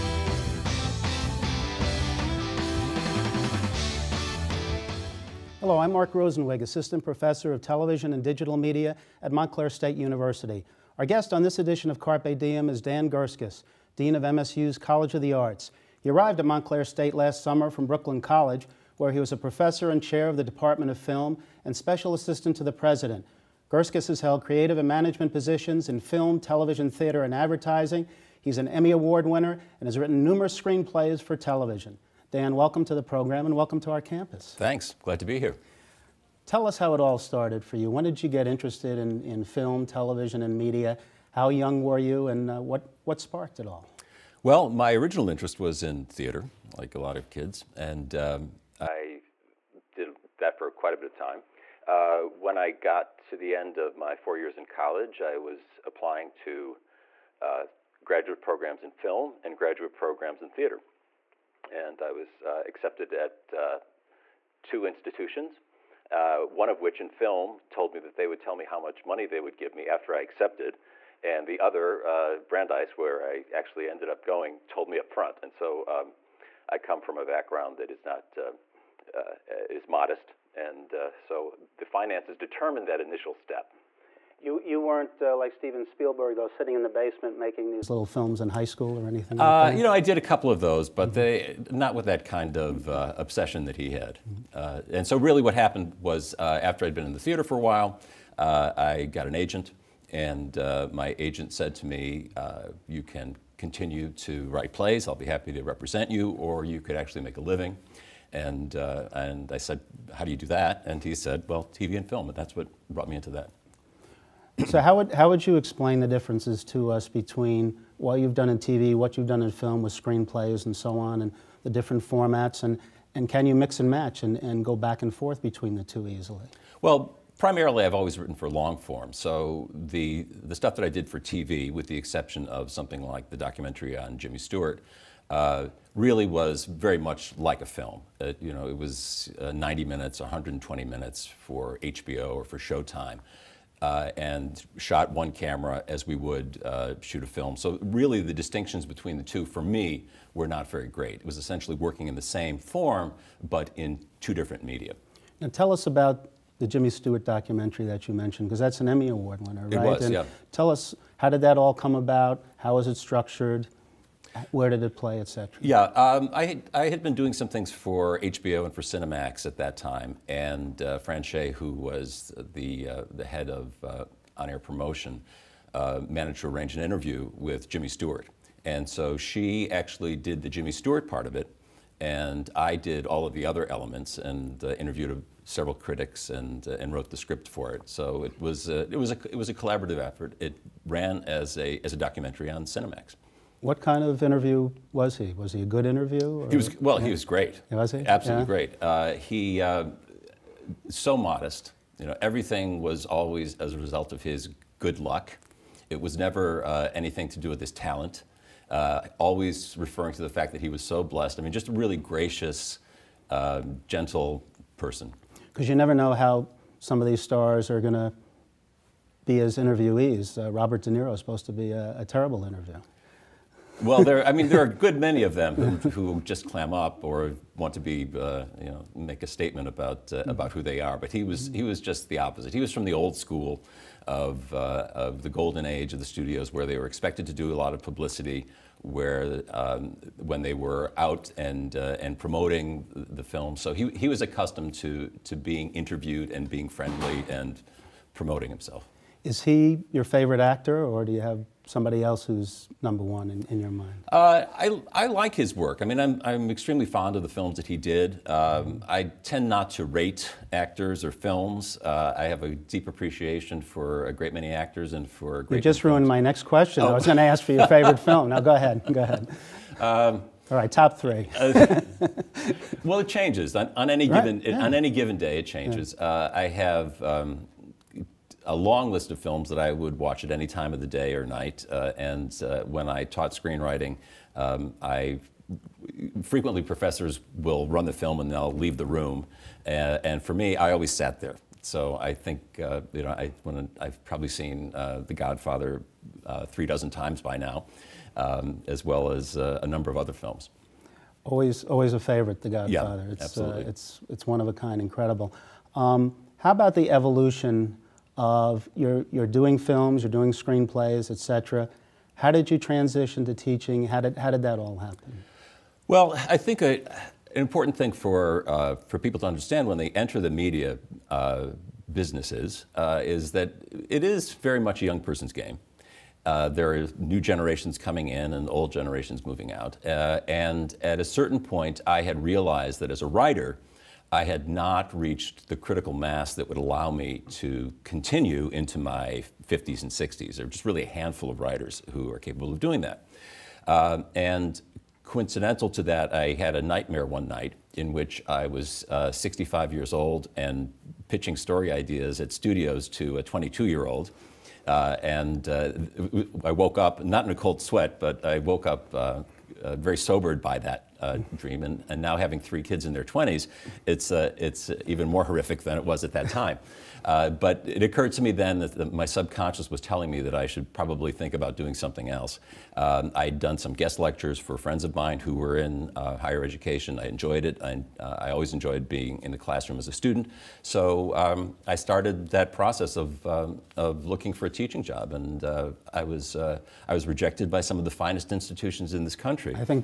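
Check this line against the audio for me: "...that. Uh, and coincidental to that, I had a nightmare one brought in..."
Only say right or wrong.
wrong.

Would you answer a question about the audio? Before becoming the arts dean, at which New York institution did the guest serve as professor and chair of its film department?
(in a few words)
Brooklyn College.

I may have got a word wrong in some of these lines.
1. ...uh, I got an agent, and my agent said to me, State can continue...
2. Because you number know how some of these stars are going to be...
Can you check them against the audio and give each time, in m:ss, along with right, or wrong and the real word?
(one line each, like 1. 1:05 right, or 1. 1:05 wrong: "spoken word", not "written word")
1. 1:38 wrong: "You", not "State"
2. 3:35 wrong: "never", not "number".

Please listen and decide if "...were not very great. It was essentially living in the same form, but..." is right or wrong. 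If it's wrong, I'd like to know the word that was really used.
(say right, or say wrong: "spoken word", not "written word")
wrong: "working", not "living".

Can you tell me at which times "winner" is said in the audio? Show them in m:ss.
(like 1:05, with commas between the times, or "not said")
0:29, 2:39.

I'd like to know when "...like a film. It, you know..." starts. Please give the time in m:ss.
2:17.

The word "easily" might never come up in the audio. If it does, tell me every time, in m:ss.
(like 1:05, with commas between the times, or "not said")
2:06.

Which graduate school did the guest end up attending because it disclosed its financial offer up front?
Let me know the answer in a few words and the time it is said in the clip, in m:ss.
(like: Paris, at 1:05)
Brandeis, at 1:12.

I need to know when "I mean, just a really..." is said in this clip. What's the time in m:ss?
3:31.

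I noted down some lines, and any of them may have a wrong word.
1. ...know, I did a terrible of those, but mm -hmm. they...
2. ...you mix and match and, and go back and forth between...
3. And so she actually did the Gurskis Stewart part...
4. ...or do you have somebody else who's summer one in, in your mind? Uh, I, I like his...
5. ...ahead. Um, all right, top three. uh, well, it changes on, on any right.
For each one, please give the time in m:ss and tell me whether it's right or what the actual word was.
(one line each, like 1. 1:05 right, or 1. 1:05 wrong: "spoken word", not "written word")
1. 1:29 wrong: "couple", not "terrible"
2. 2:03 right
3. 2:58 wrong: "Jimmy", not "Gurskis"
4. 4:10 wrong: "number", not "summer"
5. 4:29 right.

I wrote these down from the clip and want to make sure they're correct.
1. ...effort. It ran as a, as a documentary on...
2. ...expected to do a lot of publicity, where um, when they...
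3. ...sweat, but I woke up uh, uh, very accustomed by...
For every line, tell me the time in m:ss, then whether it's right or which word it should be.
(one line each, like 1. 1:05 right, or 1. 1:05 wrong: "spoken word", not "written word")
1. 3:09 right
2. 3:56 right
3. 5:57 wrong: "sobered", not "accustomed".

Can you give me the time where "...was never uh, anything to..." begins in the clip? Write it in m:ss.
3:26.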